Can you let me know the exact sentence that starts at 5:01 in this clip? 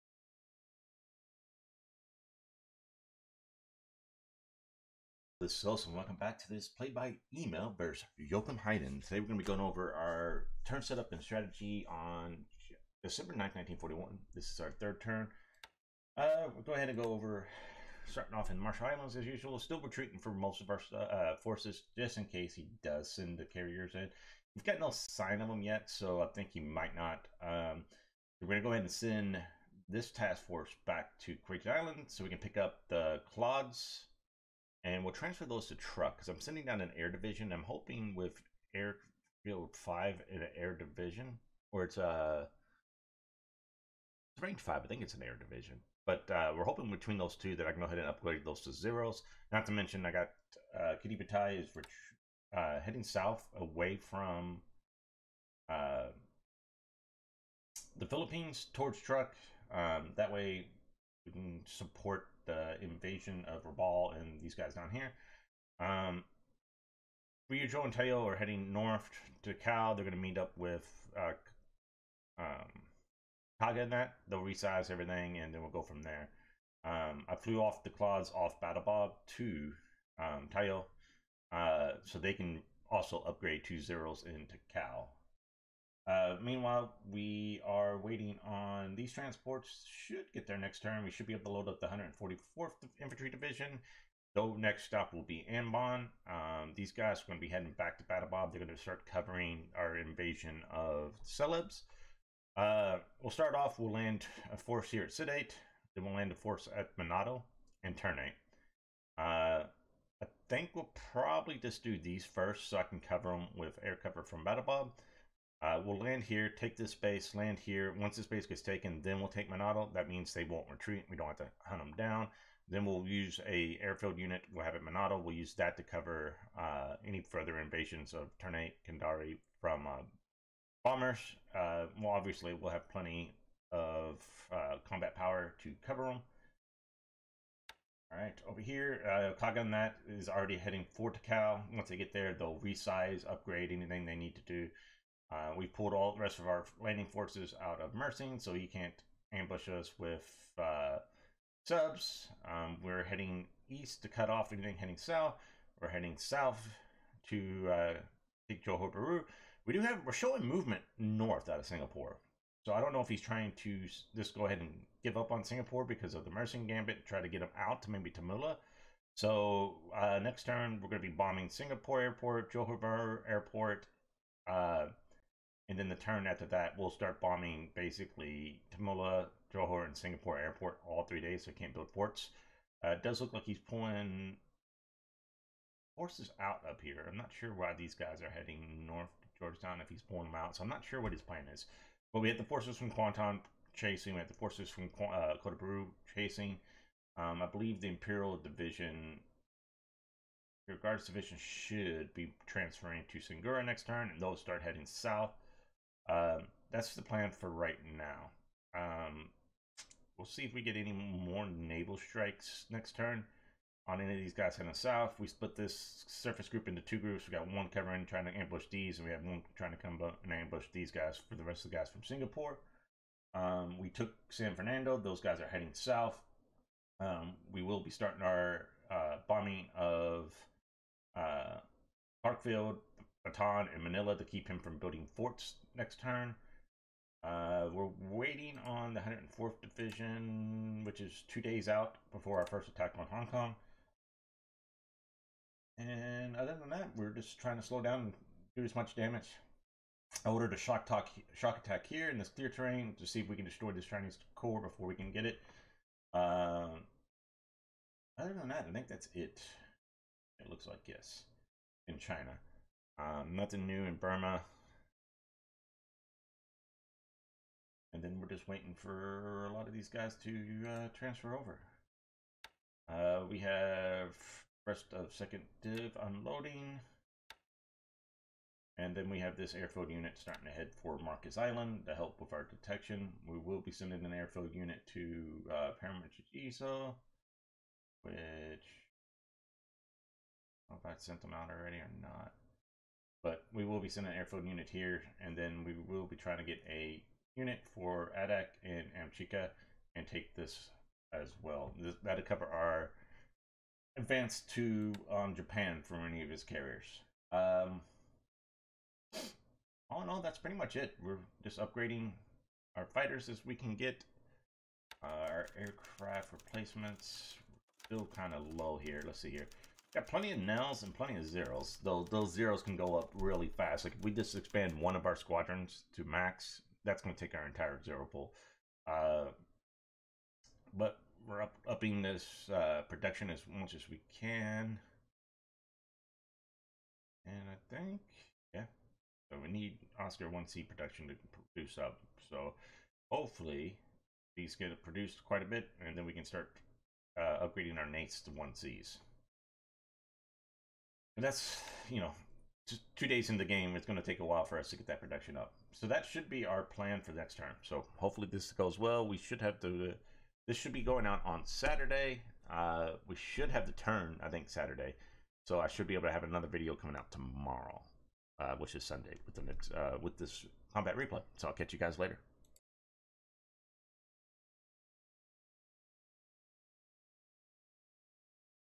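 This, that'll cover our advance to um, Japan for any of his carriers.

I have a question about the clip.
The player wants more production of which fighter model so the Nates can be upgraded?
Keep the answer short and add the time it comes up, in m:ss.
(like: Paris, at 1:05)
Oscar 1C, at 5:39.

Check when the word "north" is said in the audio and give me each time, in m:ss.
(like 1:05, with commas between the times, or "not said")
1:08, 2:40, 3:08.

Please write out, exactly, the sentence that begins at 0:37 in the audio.
I'm hoping with airfield five in an air division, or it's a uh, it's range five.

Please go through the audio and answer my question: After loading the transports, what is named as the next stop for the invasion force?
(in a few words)
Ambon.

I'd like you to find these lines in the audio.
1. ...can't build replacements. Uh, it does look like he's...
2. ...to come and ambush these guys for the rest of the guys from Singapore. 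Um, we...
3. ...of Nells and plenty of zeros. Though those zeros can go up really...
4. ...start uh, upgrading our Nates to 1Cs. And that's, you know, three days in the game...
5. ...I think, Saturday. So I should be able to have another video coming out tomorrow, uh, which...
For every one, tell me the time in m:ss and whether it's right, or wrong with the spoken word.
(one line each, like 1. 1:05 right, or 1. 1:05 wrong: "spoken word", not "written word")
1. 3:01 wrong: "forts", not "replacements"
2. 3:39 right
3. 5:20 right
4. 5:46 wrong: "two", not "three"
5. 6:04 right.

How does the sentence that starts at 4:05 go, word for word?
And other than that, we're just trying to slow down and do as much damage.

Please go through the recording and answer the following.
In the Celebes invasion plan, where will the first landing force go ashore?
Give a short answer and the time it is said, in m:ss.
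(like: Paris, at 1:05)
Sidate, at 1:45.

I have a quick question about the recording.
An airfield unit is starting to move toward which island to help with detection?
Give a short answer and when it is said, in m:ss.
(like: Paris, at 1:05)
Marcus Island, at 4:40.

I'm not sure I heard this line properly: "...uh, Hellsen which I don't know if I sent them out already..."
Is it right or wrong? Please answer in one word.
wrong.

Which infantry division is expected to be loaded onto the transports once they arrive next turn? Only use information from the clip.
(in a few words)
144th Infantry Division.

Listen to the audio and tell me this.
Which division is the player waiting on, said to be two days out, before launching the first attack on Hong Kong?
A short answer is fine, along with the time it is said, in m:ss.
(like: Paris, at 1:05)
104th Division, at 3:58.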